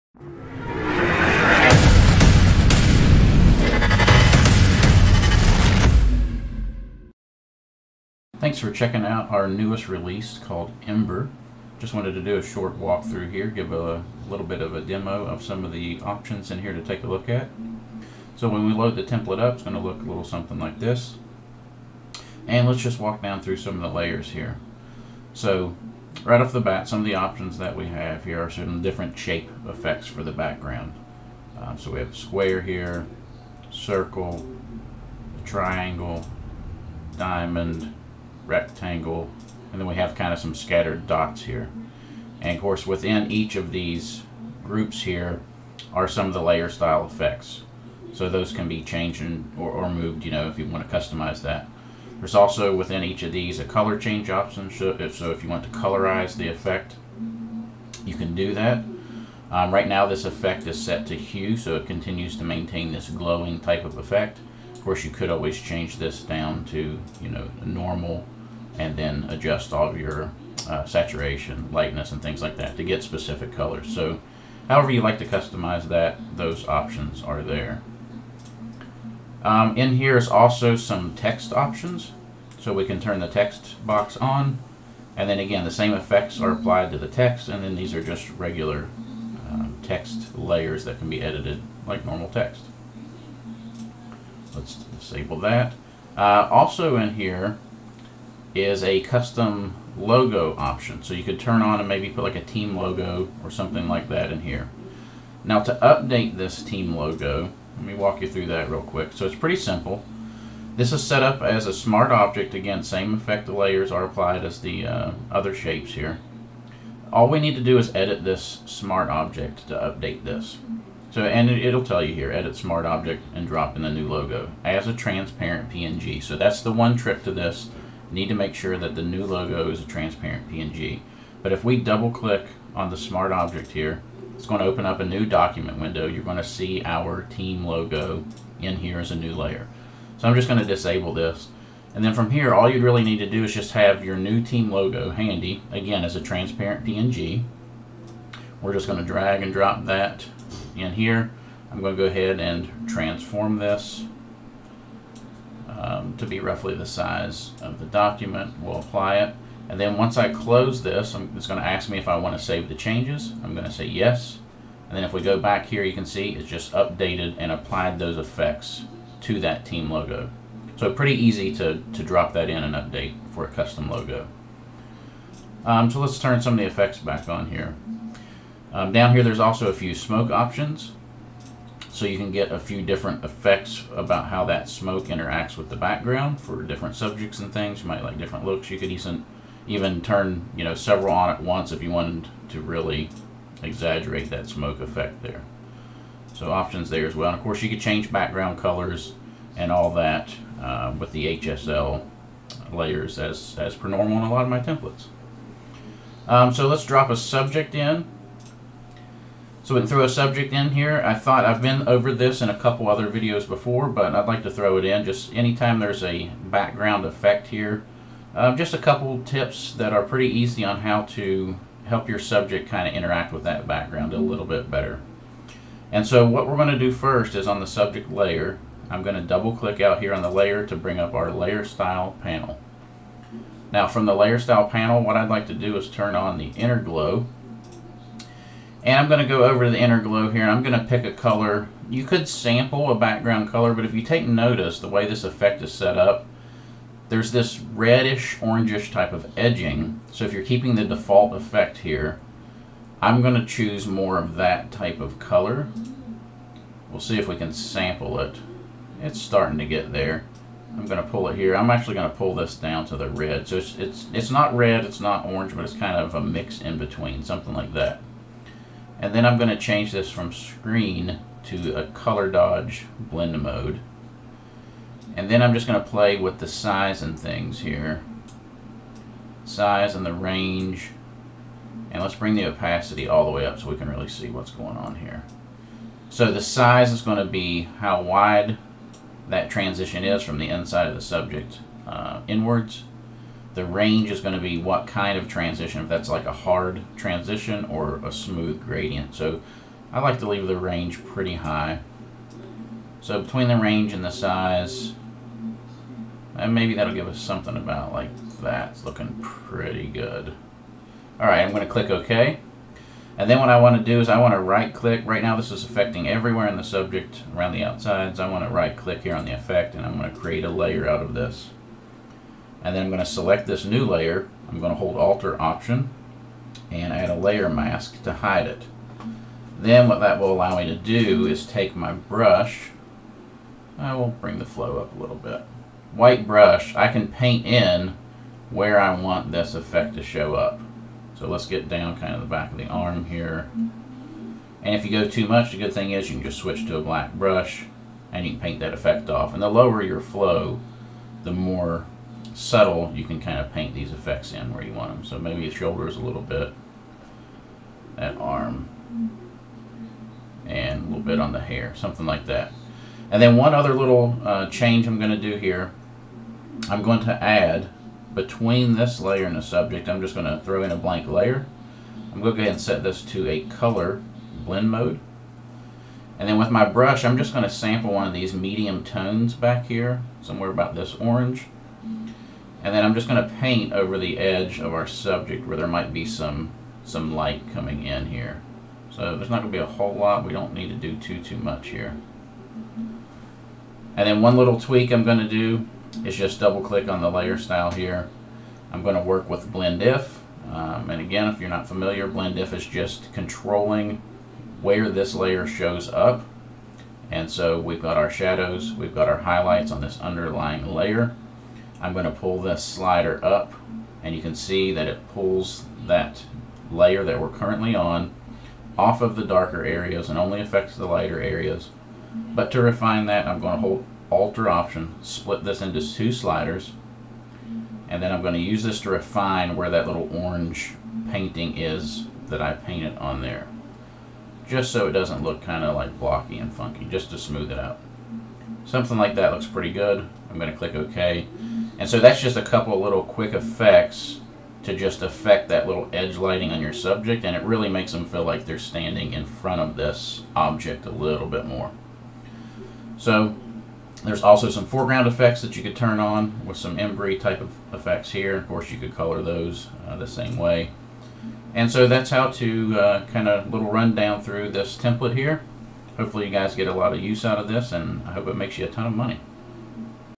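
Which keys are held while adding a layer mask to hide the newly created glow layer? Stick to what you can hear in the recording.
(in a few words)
Alt or Option.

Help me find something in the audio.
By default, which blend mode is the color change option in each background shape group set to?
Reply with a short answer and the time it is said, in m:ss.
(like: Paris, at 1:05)
hue, at 1:01.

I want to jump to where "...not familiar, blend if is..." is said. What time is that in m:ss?
6:41.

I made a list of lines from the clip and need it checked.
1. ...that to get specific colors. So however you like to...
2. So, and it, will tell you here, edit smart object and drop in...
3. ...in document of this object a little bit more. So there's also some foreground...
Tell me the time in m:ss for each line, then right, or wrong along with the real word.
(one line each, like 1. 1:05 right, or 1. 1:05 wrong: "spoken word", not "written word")
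1. 1:12 right
2. 2:01 right
3. 7:29 wrong: "front", not "document".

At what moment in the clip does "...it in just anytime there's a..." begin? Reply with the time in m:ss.
3:34.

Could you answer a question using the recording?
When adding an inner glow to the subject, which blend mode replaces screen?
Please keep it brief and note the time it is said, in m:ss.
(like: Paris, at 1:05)
color dodge, at 4:31.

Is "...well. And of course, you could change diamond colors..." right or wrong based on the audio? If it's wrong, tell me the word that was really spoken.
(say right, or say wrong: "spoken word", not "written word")
wrong: "background", not "diamond".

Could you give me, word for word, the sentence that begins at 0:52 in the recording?
There's also within each of these a color change option.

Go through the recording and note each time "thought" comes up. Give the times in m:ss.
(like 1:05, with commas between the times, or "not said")
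3:31.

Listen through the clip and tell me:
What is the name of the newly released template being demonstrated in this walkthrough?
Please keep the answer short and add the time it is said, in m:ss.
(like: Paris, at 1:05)
Ember, at 0:10.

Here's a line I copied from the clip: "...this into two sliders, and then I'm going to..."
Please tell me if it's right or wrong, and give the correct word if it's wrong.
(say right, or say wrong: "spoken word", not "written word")
right.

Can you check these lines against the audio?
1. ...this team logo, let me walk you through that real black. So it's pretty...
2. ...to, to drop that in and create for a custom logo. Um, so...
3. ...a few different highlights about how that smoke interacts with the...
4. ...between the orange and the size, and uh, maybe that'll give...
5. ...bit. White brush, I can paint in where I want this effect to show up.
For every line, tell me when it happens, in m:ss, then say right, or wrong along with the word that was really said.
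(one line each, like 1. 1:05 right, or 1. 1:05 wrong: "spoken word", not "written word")
1. 1:46 wrong: "quick", not "black"
2. 2:51 wrong: "update", not "create"
3. 3:02 wrong: "effects", not "highlights"
4. 5:03 wrong: "range", not "orange"
5. 5:35 right.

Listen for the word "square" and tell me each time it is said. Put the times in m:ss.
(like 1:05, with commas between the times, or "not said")
0:32.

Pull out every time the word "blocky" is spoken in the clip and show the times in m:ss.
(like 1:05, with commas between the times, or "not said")
7:15.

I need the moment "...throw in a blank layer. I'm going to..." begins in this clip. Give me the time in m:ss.
6:10.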